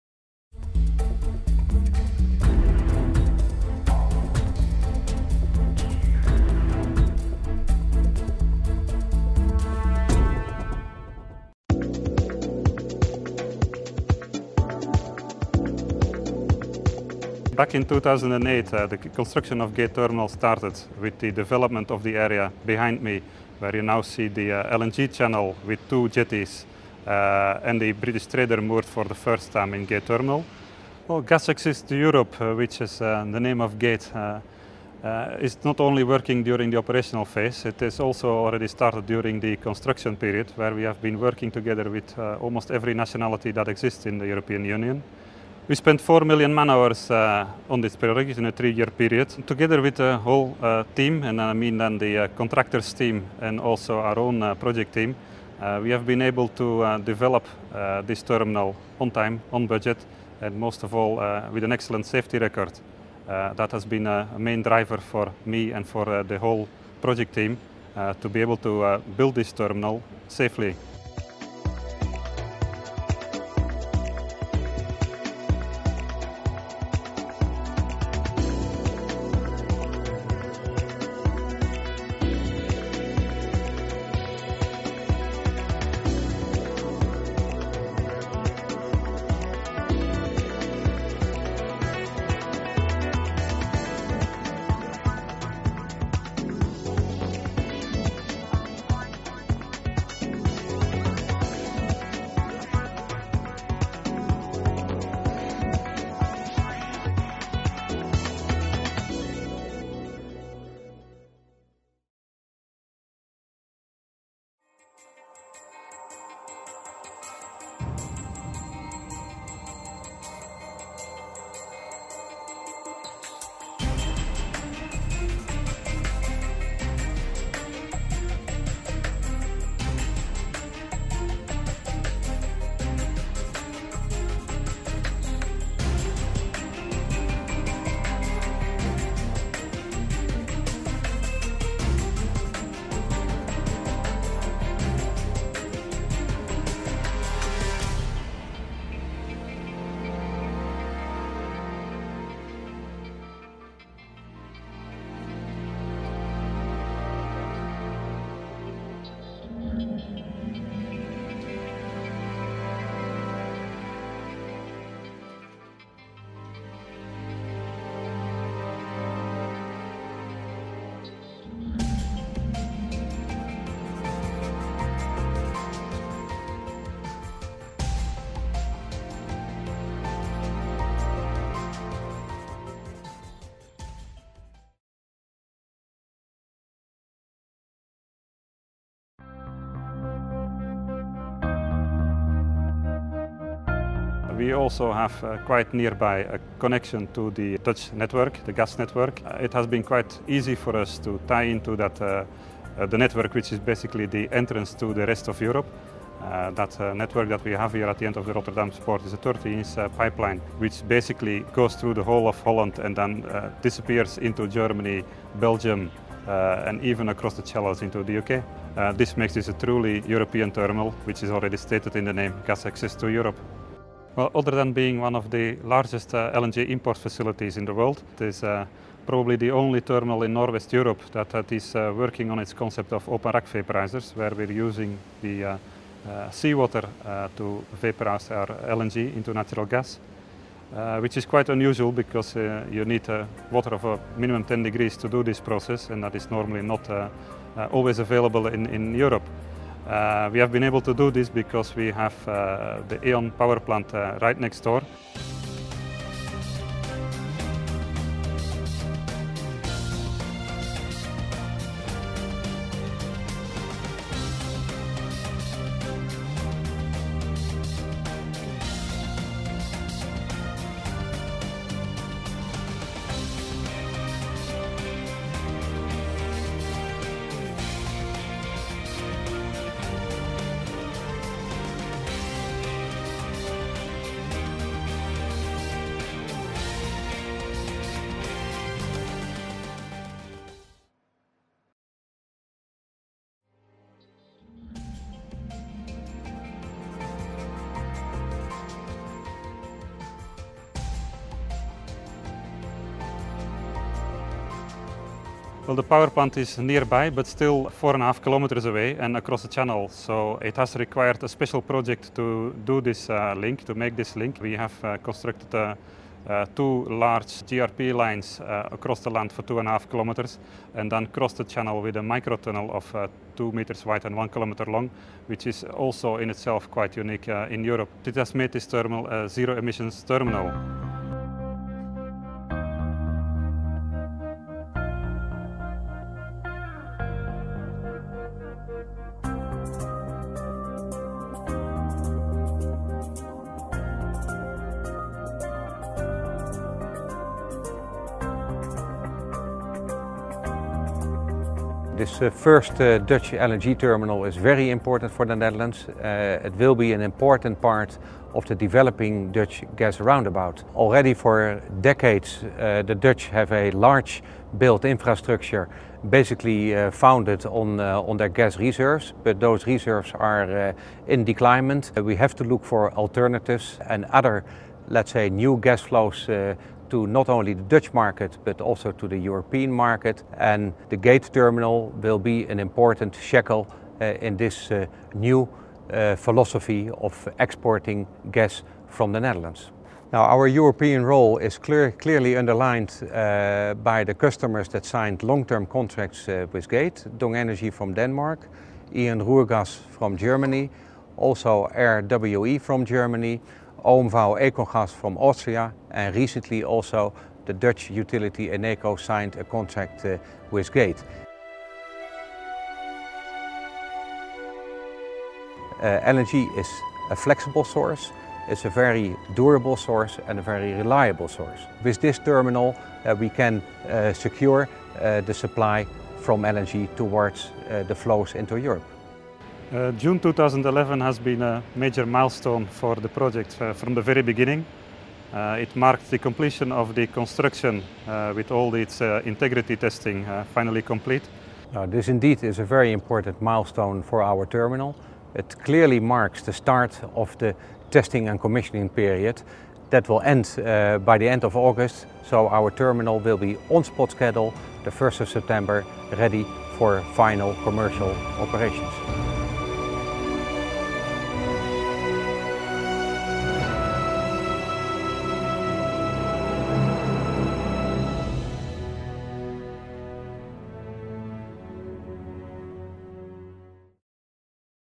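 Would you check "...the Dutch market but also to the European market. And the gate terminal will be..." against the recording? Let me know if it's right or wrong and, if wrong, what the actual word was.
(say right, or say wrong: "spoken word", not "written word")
right.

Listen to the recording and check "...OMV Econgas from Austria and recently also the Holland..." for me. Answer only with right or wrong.
wrong.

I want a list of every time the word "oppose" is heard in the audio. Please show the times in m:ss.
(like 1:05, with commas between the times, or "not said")
not said.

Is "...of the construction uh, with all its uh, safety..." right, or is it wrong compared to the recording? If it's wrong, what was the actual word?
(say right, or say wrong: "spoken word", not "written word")
wrong: "integrity", not "safety".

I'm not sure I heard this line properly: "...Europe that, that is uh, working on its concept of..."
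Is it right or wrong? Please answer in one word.
right.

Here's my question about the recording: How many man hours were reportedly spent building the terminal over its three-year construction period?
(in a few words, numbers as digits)
4 million.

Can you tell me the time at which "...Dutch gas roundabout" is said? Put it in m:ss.
5:59.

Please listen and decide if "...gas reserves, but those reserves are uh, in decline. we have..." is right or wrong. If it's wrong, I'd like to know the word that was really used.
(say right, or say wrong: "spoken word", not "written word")
right.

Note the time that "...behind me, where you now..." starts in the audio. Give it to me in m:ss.
0:22.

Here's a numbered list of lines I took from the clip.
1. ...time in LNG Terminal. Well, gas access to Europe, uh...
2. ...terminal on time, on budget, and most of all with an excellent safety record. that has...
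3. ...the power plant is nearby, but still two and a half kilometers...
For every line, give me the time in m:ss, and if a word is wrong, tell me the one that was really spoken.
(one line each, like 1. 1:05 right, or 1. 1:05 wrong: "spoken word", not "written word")
1. 0:29 wrong: "Gate", not "LNG"
2. 0:58 right
3. 5:05 wrong: "four", not "two".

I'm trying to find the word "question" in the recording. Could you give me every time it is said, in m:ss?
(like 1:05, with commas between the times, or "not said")
not said.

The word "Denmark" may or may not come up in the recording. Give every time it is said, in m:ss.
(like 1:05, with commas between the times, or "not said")
6:37.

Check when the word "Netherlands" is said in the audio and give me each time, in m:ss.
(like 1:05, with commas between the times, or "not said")
5:55, 6:29.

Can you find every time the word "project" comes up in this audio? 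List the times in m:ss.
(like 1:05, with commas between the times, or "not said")
0:47, 0:54, 1:07, 5:11, 7:13.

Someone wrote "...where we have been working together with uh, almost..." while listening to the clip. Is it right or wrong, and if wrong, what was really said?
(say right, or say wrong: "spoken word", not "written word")
right.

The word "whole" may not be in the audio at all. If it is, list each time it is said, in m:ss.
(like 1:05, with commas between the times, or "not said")
0:50, 1:06, 3:32.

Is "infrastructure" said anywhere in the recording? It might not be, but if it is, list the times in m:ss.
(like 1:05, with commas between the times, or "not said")
6:04.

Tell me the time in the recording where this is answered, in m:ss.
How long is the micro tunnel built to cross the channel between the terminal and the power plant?
5:24.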